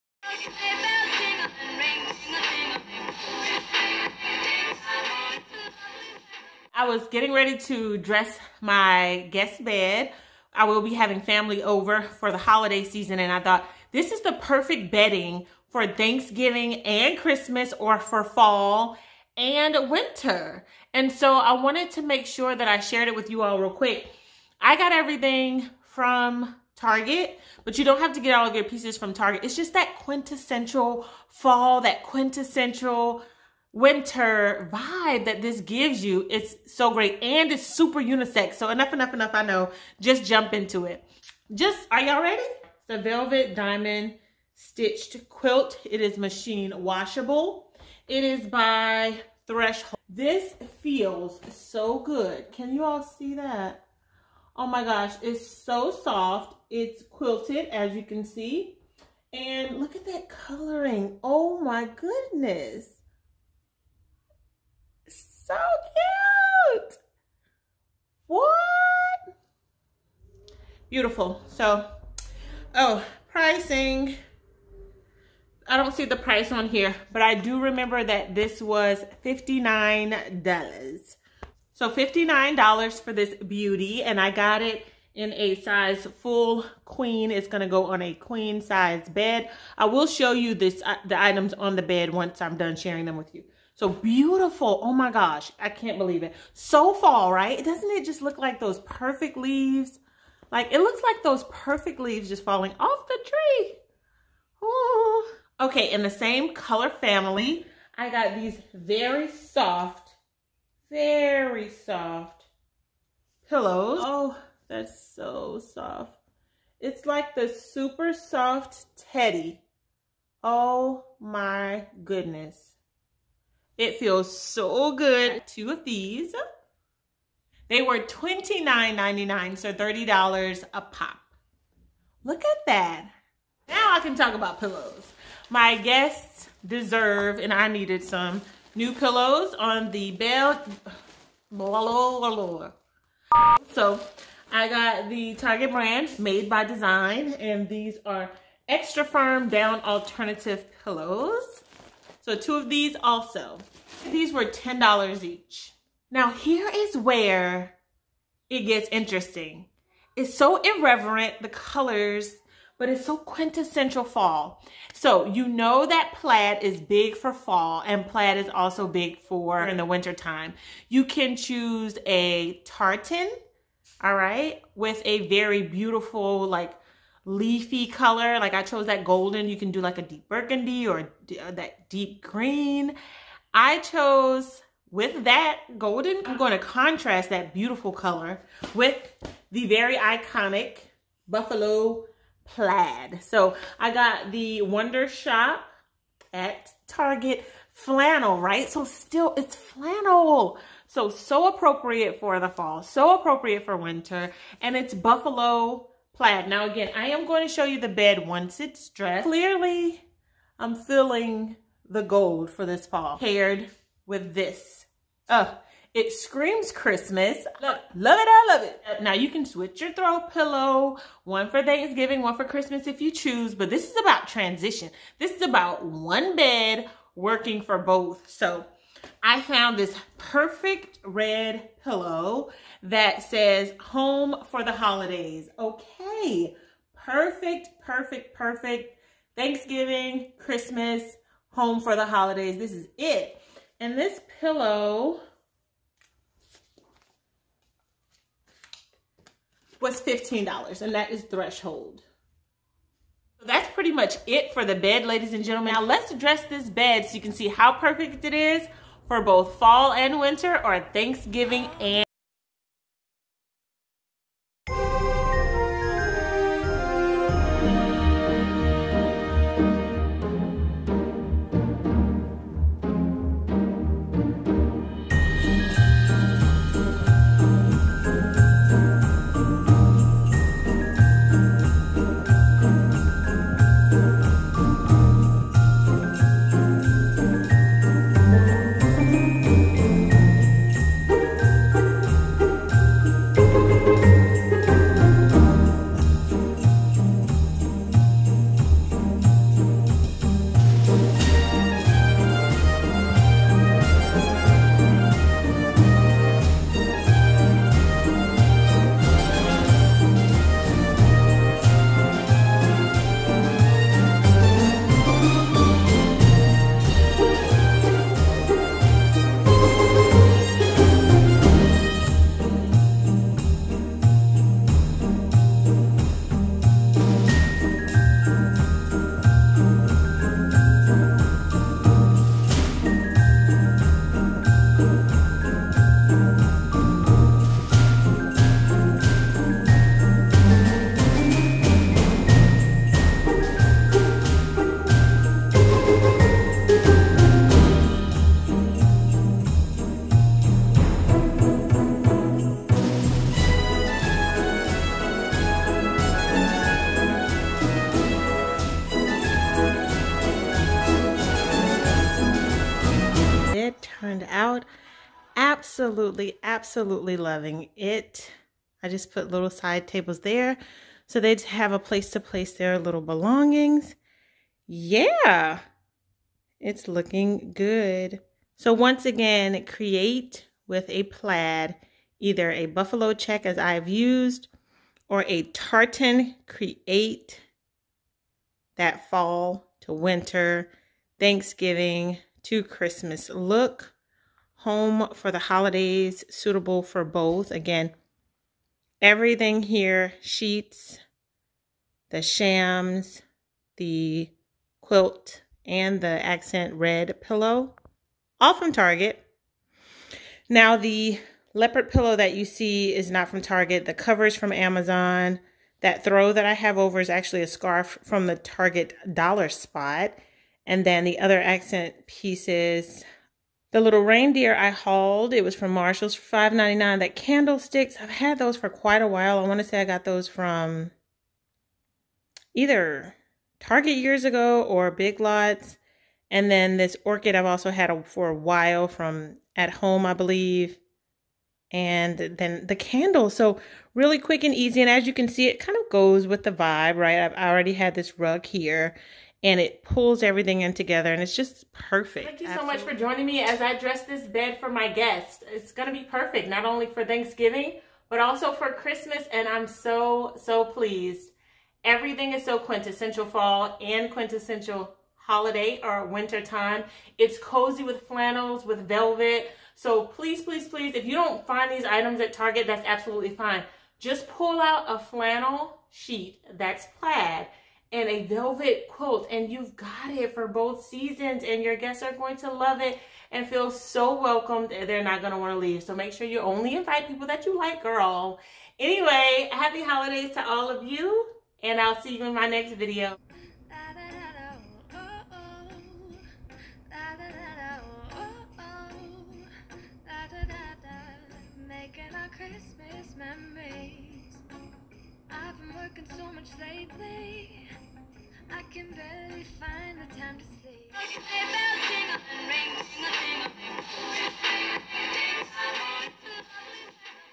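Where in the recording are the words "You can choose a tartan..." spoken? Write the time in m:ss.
2:50.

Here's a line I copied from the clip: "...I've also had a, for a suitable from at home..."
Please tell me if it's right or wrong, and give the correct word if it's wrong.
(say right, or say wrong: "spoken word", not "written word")
wrong: "while", not "suitable".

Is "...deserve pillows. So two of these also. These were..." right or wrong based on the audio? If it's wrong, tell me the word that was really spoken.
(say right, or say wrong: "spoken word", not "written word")
wrong: "alternative", not "deserve".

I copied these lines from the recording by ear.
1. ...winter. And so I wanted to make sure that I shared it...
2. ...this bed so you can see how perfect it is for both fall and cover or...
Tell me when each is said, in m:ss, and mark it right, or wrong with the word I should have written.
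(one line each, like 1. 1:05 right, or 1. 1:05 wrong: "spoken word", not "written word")
1. 0:19 right
2. 4:16 wrong: "winter", not "cover".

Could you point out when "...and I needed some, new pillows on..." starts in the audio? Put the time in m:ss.
2:17.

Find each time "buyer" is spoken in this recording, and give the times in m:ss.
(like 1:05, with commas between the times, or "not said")
not said.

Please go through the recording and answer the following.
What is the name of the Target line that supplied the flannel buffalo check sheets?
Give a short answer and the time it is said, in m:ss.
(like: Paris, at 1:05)
Wondershop, at 3:14.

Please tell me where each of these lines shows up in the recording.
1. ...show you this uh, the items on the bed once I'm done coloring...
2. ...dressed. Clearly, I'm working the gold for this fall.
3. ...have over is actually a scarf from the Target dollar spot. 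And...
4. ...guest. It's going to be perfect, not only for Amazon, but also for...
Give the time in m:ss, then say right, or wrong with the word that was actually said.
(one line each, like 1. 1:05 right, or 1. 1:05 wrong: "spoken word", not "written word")
1. 1:30 wrong: "sharing", not "coloring"
2. 3:28 wrong: "feeling", not "working"
3. 6:56 right
4. 7:34 wrong: "Thanksgiving", not "Amazon".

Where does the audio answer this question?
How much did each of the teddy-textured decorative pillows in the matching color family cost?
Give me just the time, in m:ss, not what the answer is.
2:07.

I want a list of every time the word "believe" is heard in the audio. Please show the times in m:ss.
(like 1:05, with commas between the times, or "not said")
1:35, 7:20.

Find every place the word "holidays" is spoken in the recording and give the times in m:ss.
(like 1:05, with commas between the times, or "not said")
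0:12, 3:54, 4:02, 6:35, 7:45, 8:09.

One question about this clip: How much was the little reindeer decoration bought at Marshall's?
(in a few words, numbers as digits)
$5.99.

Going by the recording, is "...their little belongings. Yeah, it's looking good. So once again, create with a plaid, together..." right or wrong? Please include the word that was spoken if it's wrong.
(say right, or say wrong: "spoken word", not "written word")
wrong: "either", not "together".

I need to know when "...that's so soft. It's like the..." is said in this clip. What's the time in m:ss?
1:54.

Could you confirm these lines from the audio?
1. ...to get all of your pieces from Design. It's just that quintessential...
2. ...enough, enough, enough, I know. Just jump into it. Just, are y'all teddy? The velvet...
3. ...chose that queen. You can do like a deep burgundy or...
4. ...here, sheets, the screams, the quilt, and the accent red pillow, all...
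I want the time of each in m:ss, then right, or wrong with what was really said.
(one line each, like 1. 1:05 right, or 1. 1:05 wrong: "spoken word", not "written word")
1. 0:28 wrong: "Target", not "Design"
2. 0:38 wrong: "ready", not "teddy"
3. 2:58 wrong: "golden", not "queen"
4. 6:39 wrong: "shams", not "screams".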